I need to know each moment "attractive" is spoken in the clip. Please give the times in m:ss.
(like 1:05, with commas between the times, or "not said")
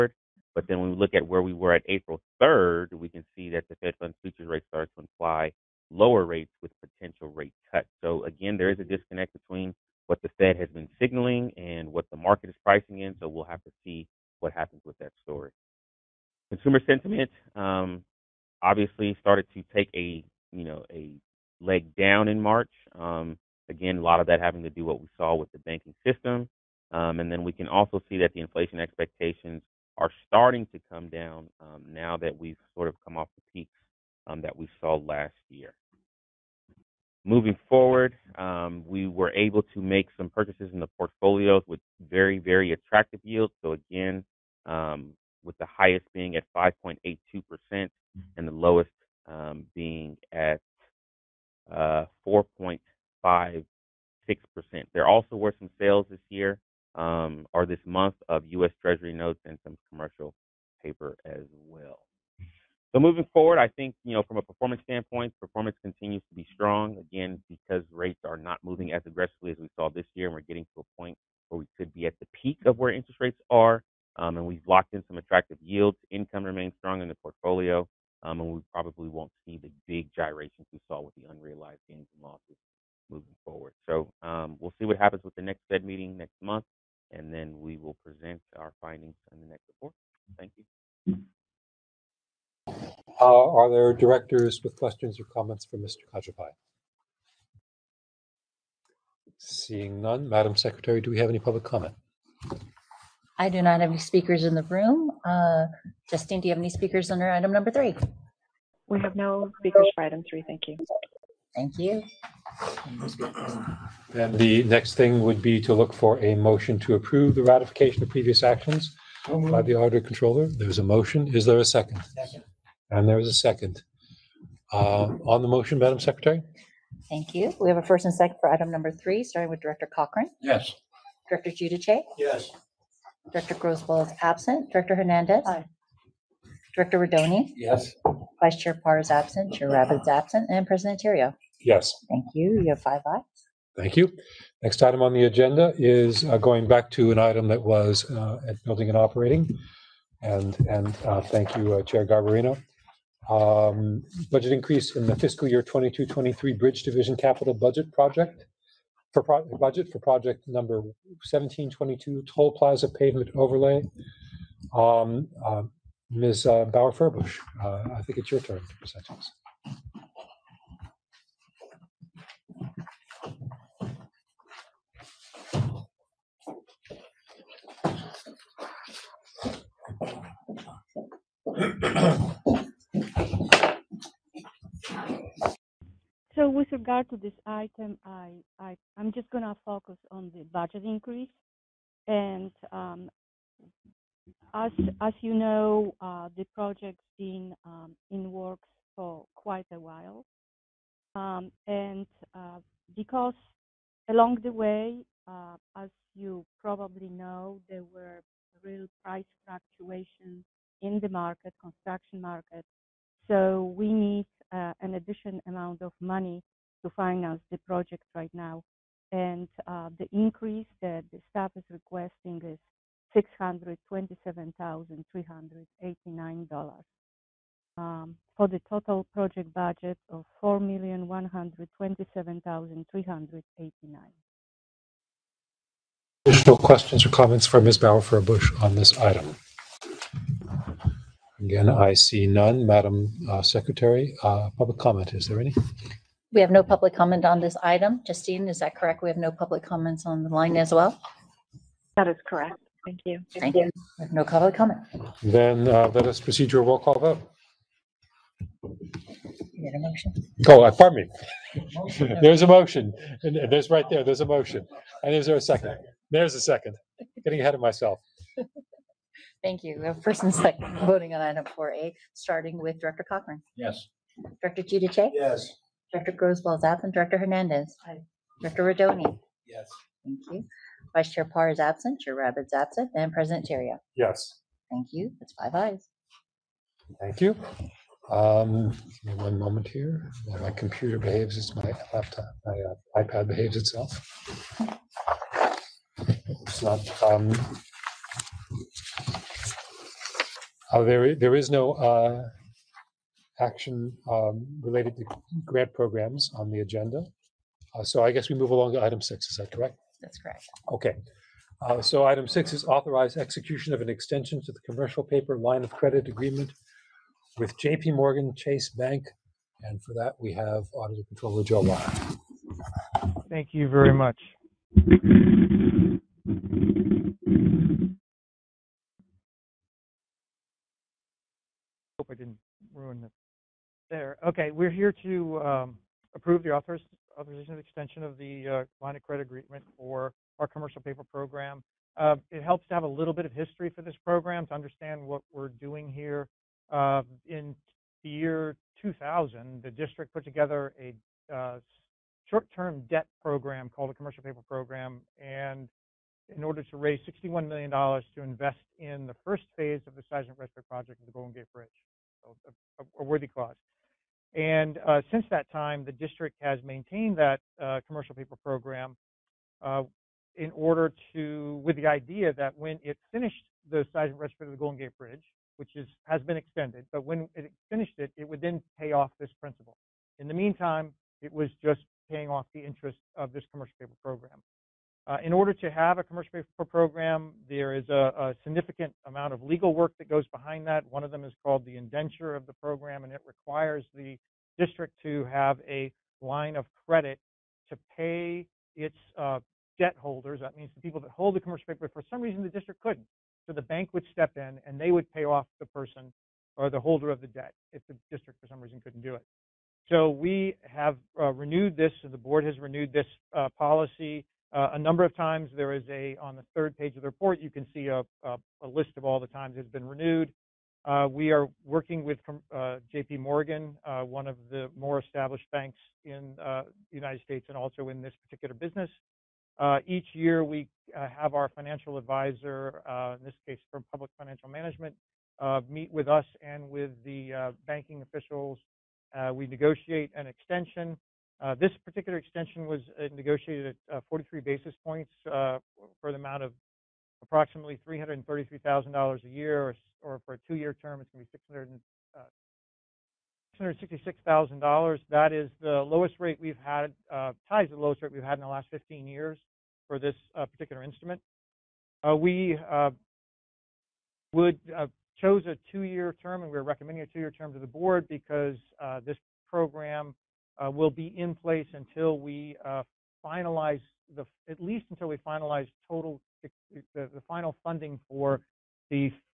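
0:42, 1:15.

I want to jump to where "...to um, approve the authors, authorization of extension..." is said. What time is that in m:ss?
5:35.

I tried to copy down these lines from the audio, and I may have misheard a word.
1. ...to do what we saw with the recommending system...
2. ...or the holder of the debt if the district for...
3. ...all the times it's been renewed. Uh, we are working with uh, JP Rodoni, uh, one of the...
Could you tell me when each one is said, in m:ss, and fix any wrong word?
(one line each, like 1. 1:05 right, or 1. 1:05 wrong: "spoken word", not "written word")
1. 0:24 wrong: "banking", not "recommending"
2. 6:46 right
3. 6:59 wrong: "Morgan", not "Rodoni".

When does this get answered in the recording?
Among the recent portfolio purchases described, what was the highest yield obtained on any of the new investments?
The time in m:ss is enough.
0:46.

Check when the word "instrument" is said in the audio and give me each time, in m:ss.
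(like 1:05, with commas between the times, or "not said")
7:40.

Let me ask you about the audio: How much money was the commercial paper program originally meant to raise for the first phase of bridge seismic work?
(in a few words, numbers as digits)
$61 million.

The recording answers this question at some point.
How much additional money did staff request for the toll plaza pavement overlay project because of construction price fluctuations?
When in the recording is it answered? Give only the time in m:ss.
3:43.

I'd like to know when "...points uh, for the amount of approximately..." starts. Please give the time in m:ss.
7:24.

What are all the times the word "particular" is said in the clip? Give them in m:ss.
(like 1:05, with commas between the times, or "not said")
7:08, 7:21, 7:40.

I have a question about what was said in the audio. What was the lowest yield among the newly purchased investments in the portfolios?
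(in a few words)
4.56%.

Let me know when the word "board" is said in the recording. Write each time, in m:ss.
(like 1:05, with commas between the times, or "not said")
6:52, 7:47.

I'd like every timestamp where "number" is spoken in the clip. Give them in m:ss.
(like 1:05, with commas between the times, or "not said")
1:47, 2:08, 2:40, 6:54.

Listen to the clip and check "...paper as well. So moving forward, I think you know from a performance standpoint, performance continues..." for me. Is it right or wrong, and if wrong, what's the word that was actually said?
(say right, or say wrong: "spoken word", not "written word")
right.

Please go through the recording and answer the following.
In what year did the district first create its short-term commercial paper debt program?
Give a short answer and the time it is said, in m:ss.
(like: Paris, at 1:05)
2000, at 5:48.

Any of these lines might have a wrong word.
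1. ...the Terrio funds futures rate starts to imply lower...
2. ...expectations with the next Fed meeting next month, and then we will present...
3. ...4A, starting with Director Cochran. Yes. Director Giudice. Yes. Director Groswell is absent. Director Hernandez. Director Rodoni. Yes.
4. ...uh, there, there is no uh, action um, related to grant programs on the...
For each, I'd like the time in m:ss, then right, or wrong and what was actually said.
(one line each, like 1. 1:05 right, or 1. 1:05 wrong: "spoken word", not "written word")
1. 0:03 wrong: "Fed", not "Terrio"
2. 1:24 wrong: "happens", not "expectations"
3. 4:31 right
4. 5:00 right.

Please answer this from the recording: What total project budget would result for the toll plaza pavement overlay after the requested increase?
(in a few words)
$4,127,389.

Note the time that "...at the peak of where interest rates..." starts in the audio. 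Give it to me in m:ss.
1:12.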